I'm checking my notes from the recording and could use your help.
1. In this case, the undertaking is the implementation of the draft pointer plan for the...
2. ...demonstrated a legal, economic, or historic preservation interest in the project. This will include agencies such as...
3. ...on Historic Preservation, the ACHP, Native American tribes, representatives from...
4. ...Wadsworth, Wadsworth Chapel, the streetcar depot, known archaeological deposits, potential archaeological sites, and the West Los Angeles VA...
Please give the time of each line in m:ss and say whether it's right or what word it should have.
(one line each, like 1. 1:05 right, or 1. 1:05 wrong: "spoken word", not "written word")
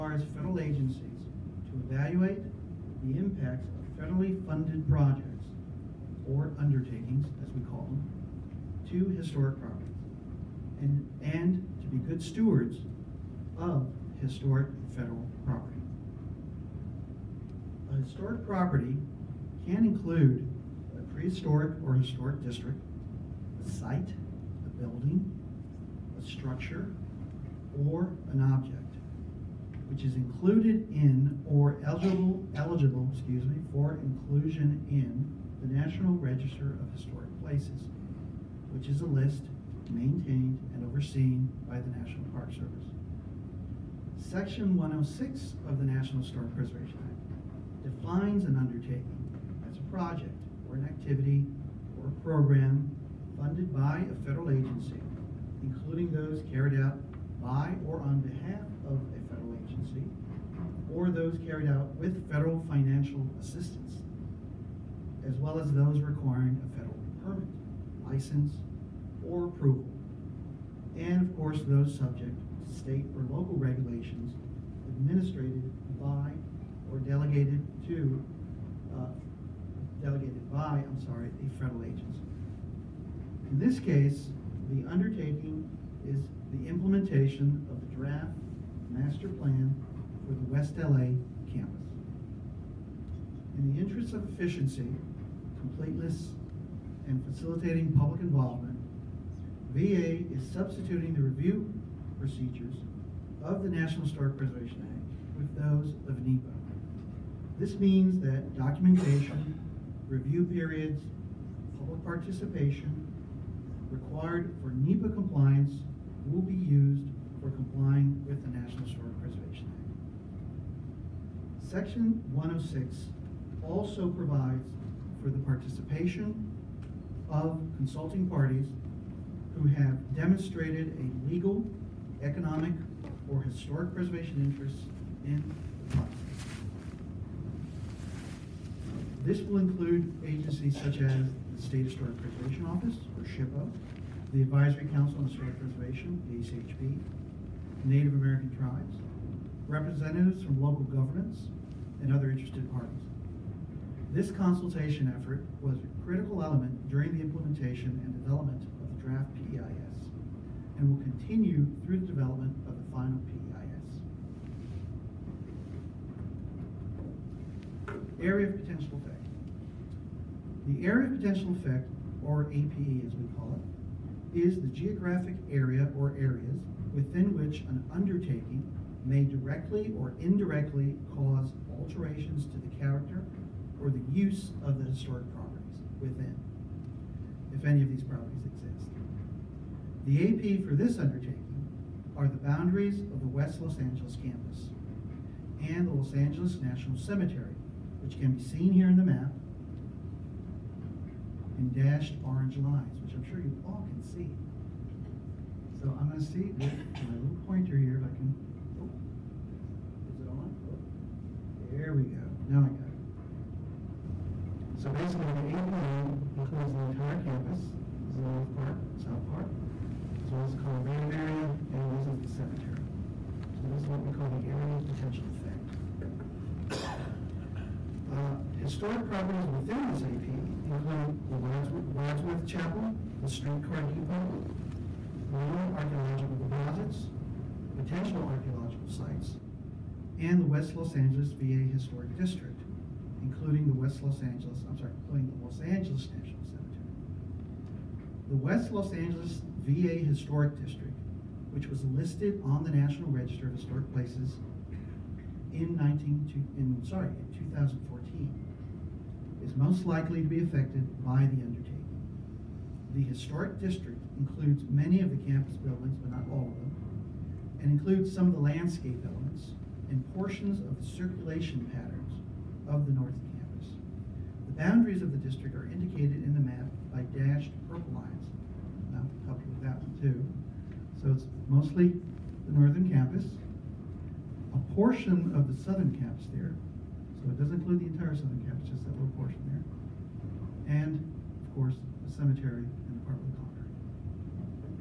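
1. 1:23 wrong: "master", not "pointer"
2. 2:10 right
3. 2:25 right
4. 3:51 right.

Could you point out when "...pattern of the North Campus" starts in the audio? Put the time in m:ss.
4:31.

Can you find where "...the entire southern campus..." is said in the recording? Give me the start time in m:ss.
4:47.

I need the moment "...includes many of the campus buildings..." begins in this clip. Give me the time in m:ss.
4:24.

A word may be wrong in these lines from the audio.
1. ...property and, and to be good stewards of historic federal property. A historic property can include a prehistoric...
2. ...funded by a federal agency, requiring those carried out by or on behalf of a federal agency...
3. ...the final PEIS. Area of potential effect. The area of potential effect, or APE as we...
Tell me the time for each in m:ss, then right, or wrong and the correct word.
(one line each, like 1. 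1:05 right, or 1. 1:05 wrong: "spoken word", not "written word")
1. 0:09 right
2. 0:53 wrong: "including", not "requiring"
3. 2:42 right.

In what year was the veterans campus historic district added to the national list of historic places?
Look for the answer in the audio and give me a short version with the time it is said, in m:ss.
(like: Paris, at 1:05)
2014, at 4:17.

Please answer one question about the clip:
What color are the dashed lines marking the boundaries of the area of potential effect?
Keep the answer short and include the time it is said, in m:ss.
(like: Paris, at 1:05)
Orange, at 3:22.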